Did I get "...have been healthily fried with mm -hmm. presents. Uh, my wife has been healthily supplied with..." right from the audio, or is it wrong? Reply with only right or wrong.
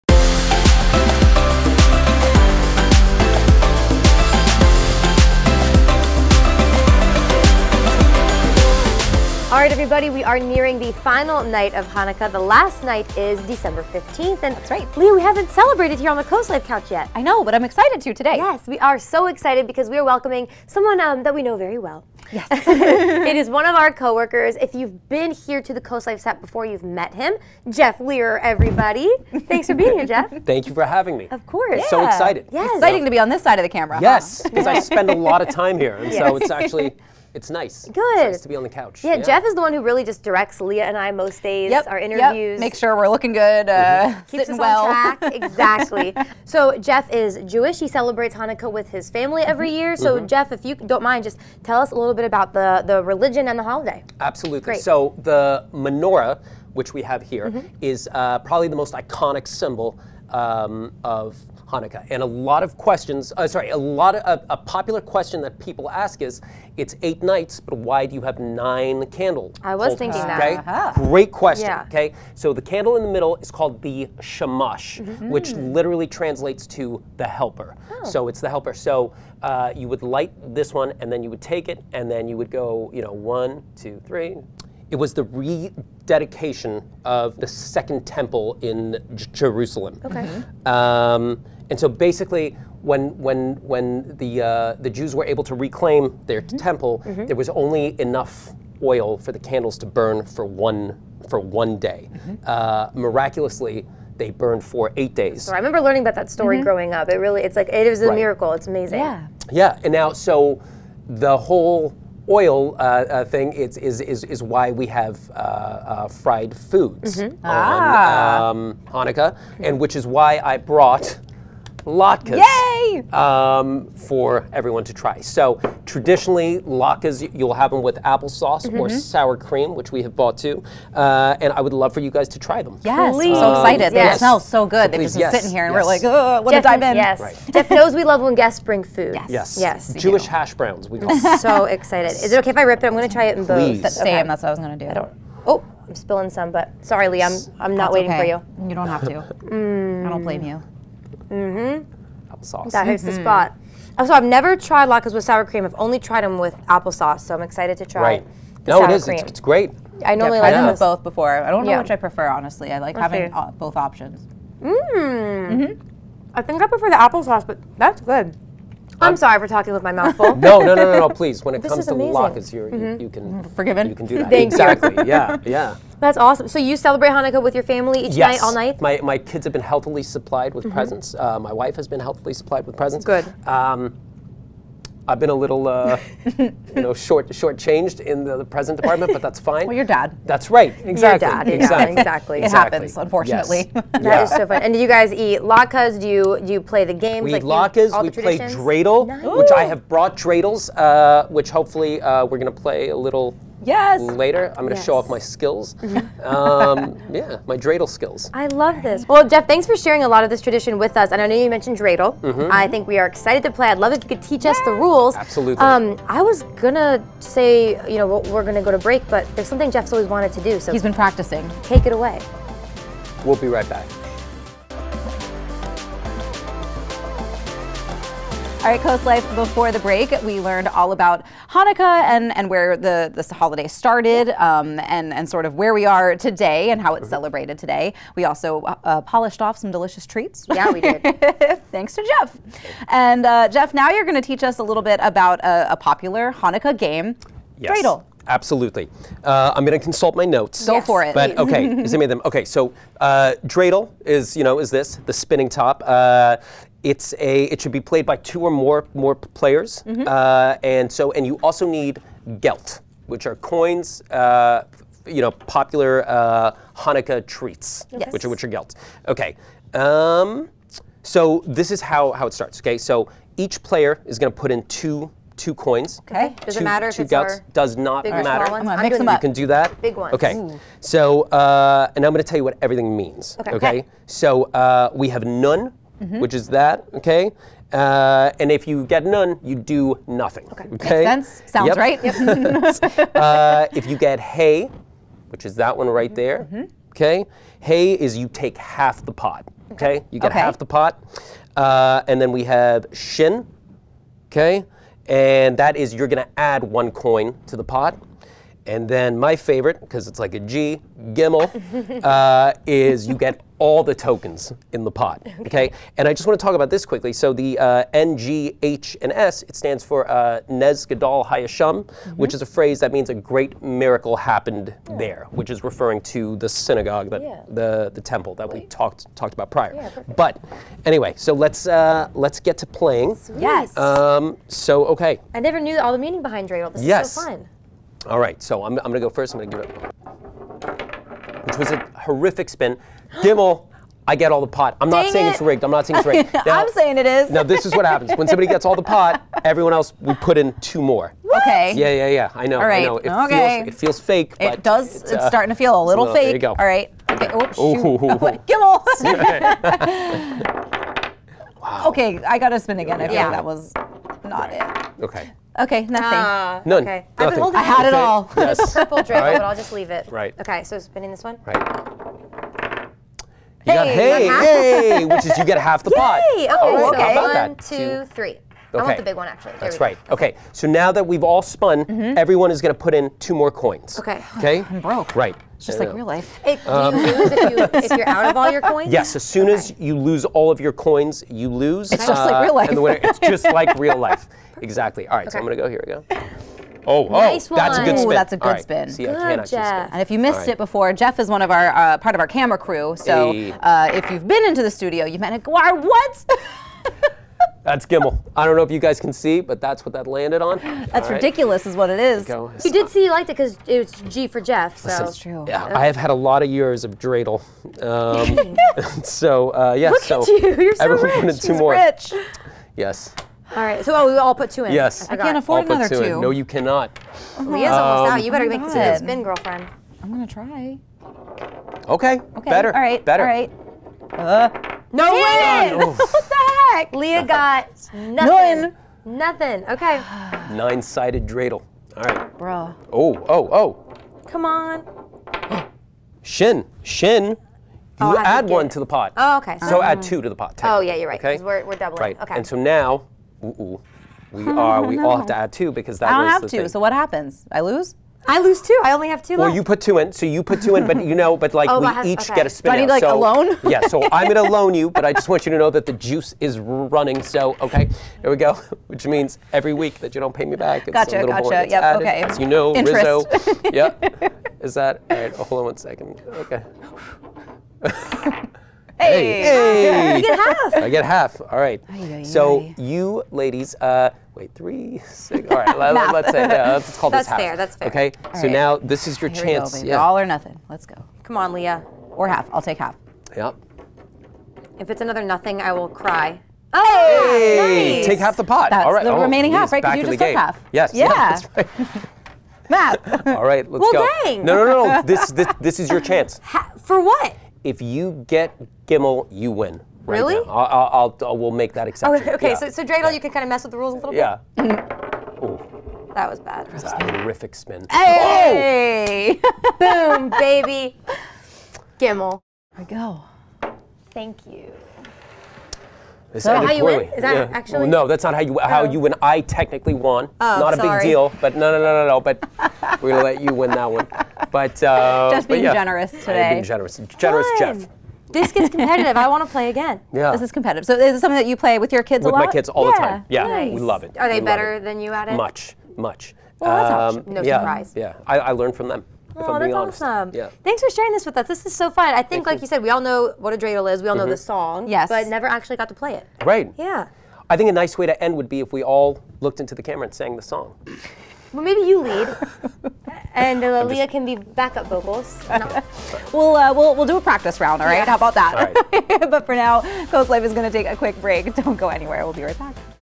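wrong.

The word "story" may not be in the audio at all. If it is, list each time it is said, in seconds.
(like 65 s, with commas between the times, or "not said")
106 s.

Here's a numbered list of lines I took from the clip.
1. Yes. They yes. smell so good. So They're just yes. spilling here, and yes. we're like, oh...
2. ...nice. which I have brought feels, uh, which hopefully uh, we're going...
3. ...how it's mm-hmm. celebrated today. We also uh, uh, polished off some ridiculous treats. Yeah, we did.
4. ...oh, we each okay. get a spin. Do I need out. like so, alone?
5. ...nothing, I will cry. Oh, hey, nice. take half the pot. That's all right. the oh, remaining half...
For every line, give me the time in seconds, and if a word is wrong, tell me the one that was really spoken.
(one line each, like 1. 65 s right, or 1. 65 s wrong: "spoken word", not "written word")
1. 133 s wrong: "sitting", not "spilling"
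2. 199 s wrong: "dreidels", not "feels"
3. 236 s wrong: "delicious", not "ridiculous"
4. 461 s right
5. 495 s right.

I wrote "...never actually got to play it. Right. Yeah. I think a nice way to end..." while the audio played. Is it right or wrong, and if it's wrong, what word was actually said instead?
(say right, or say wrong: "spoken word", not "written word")
right.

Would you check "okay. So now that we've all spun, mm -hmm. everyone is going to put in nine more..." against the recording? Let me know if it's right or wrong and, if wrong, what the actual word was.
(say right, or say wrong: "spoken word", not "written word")
wrong: "two", not "nine".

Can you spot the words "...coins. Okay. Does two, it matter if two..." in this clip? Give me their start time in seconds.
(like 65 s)
275 s.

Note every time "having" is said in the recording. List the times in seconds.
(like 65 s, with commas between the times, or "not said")
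30 s, 162 s.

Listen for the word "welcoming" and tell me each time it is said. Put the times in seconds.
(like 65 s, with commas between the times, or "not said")
20 s.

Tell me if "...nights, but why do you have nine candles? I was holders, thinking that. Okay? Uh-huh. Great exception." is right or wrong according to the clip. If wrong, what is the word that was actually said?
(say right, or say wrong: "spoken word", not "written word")
wrong: "question", not "exception".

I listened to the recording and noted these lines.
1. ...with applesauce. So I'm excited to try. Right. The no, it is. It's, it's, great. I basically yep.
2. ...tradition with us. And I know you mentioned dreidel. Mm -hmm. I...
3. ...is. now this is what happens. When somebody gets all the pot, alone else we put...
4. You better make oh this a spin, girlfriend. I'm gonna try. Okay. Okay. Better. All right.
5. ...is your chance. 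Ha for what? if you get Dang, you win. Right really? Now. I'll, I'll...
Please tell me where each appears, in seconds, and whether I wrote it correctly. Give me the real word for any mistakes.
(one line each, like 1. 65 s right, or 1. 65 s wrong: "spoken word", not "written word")
1. 156 s wrong: "normally", not "basically"
2. 210 s right
3. 347 s wrong: "everyone", not "alone"
4. 428 s right
5. 505 s wrong: "Gimmel", not "Dang".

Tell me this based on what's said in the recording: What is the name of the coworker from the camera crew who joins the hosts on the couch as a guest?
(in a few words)
Jeff Lear.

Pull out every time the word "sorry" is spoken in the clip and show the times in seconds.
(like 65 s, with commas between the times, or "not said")
63 s, 146 s, 169 s, 530 s.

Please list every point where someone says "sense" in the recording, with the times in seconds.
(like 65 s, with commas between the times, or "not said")
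291 s.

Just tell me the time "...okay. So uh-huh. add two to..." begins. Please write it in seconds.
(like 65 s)
449 s.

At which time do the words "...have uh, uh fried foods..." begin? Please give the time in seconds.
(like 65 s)
114 s.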